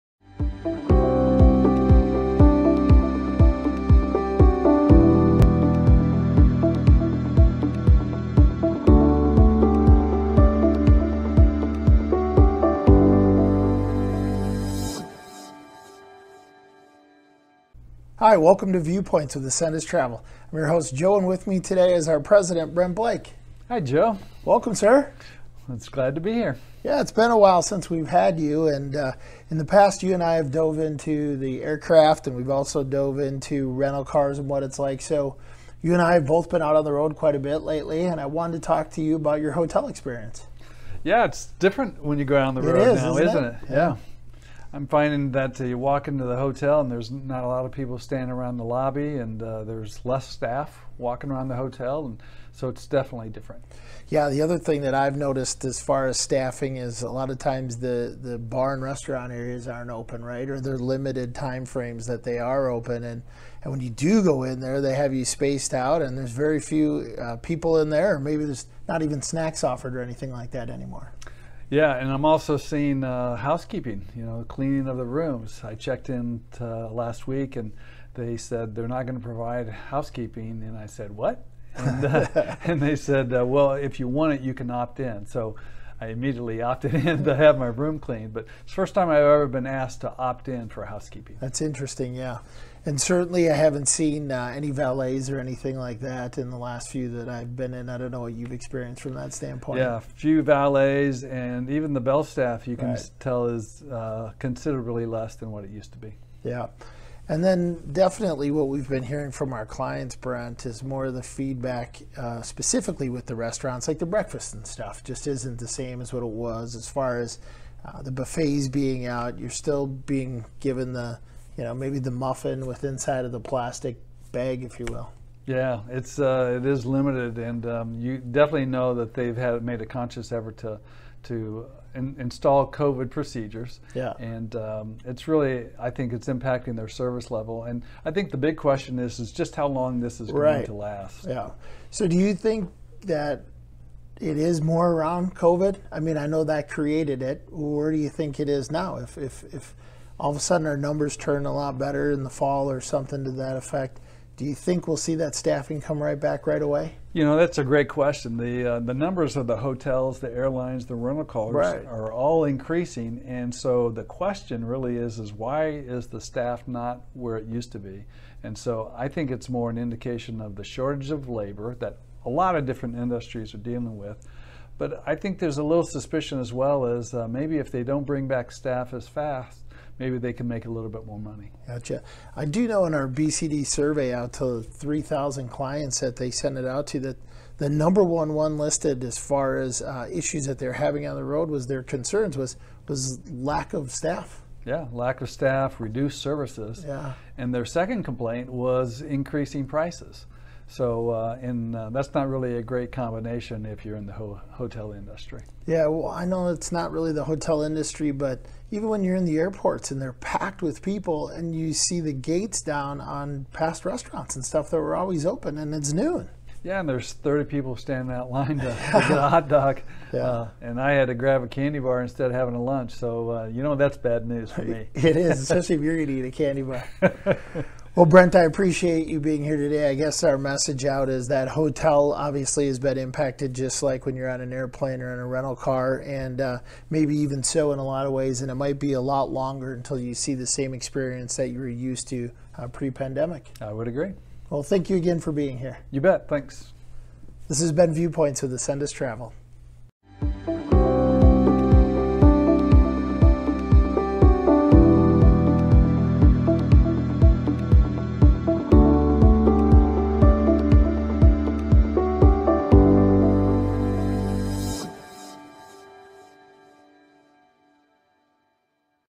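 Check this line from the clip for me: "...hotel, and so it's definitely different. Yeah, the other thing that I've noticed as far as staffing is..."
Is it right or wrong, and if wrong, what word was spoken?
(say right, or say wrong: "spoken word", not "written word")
right.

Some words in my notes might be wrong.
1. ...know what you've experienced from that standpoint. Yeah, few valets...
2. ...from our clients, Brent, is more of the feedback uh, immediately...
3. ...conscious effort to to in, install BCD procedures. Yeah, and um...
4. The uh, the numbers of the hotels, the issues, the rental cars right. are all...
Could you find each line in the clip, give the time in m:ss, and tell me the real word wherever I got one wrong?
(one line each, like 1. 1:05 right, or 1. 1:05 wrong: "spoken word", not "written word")
1. 1:38 right
2. 1:49 wrong: "specifically", not "immediately"
3. 2:09 wrong: "COVID", not "BCD"
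4. 2:38 wrong: "airlines", not "issues".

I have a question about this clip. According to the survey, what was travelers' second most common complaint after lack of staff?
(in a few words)
Increasing prices.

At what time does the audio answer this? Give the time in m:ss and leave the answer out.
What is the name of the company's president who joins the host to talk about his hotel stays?
0:22.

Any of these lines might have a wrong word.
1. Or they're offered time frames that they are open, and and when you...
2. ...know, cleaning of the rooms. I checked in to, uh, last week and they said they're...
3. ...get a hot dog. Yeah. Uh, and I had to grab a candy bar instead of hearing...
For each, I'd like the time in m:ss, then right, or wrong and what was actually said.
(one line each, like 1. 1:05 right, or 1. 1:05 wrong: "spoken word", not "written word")
1. 1:00 wrong: "limited", not "offered"
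2. 1:14 right
3. 3:38 wrong: "having", not "hearing".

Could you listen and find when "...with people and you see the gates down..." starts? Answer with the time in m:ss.
3:30.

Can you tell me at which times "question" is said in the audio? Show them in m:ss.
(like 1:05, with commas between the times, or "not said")
2:18, 2:37, 2:44.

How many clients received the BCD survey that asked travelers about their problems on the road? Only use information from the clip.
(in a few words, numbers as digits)
3,000.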